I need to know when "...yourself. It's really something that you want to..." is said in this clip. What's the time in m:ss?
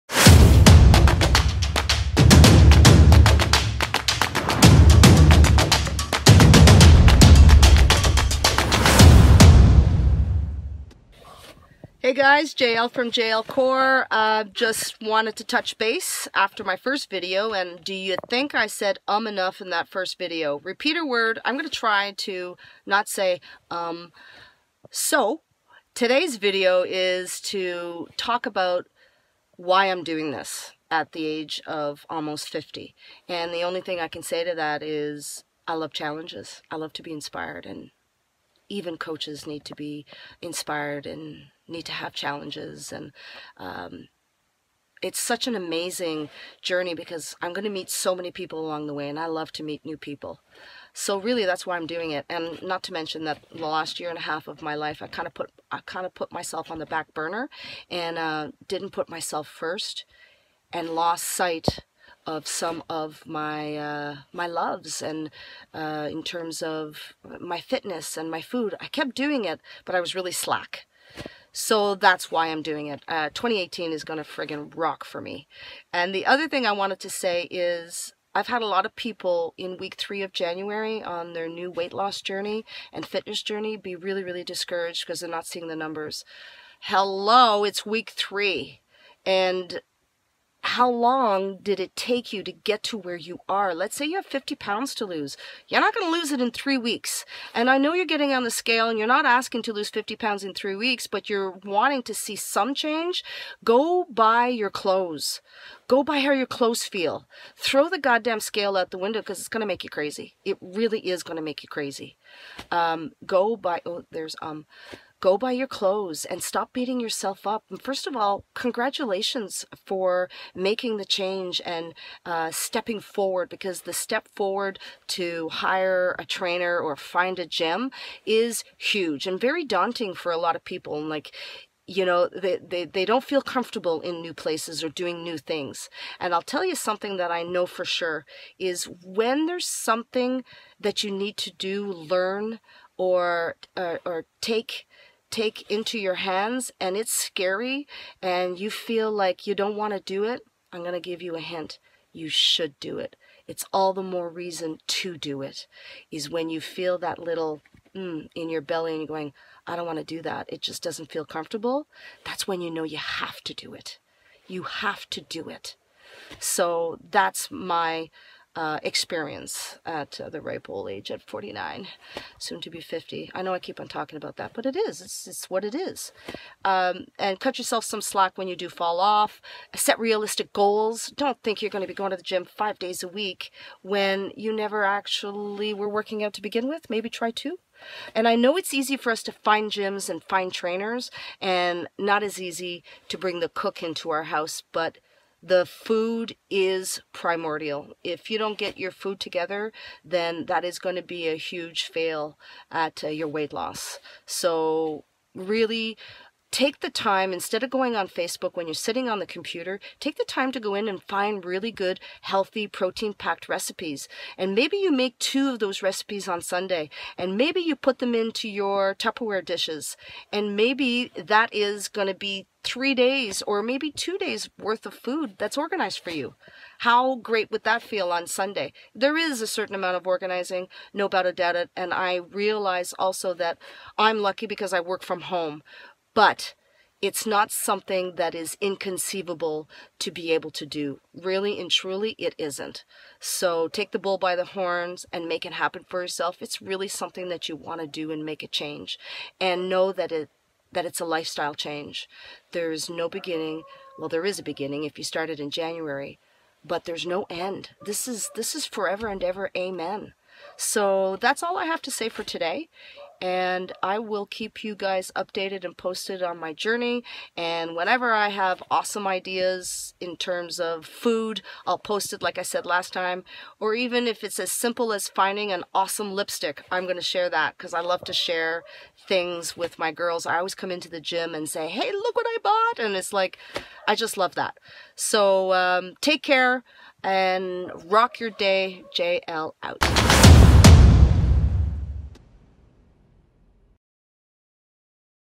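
4:06.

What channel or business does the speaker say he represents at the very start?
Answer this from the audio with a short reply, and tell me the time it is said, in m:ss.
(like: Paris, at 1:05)
JL Core, at 0:13.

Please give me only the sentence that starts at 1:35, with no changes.
You're not going to lose it in three weeks.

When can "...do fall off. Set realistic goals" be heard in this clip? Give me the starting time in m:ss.
2:58.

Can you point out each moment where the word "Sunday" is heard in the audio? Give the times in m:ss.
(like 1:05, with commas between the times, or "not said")
3:36, 3:48.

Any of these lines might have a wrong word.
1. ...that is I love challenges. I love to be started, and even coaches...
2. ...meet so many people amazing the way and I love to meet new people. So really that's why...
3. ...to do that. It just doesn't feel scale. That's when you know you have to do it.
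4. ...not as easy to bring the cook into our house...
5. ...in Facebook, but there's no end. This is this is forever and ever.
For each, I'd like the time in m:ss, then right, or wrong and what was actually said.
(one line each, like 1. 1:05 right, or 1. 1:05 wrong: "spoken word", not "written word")
1. 0:34 wrong: "inspired", not "started"
2. 0:47 wrong: "along", not "amazing"
3. 2:39 wrong: "comfortable", not "scale"
4. 3:11 right
5. 4:15 wrong: "January", not "Facebook".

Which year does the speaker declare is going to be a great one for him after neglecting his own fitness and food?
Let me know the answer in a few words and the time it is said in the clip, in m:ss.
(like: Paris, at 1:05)
2018, at 1:13.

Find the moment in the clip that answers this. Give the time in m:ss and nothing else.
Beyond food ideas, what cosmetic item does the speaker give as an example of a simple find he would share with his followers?
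4:36.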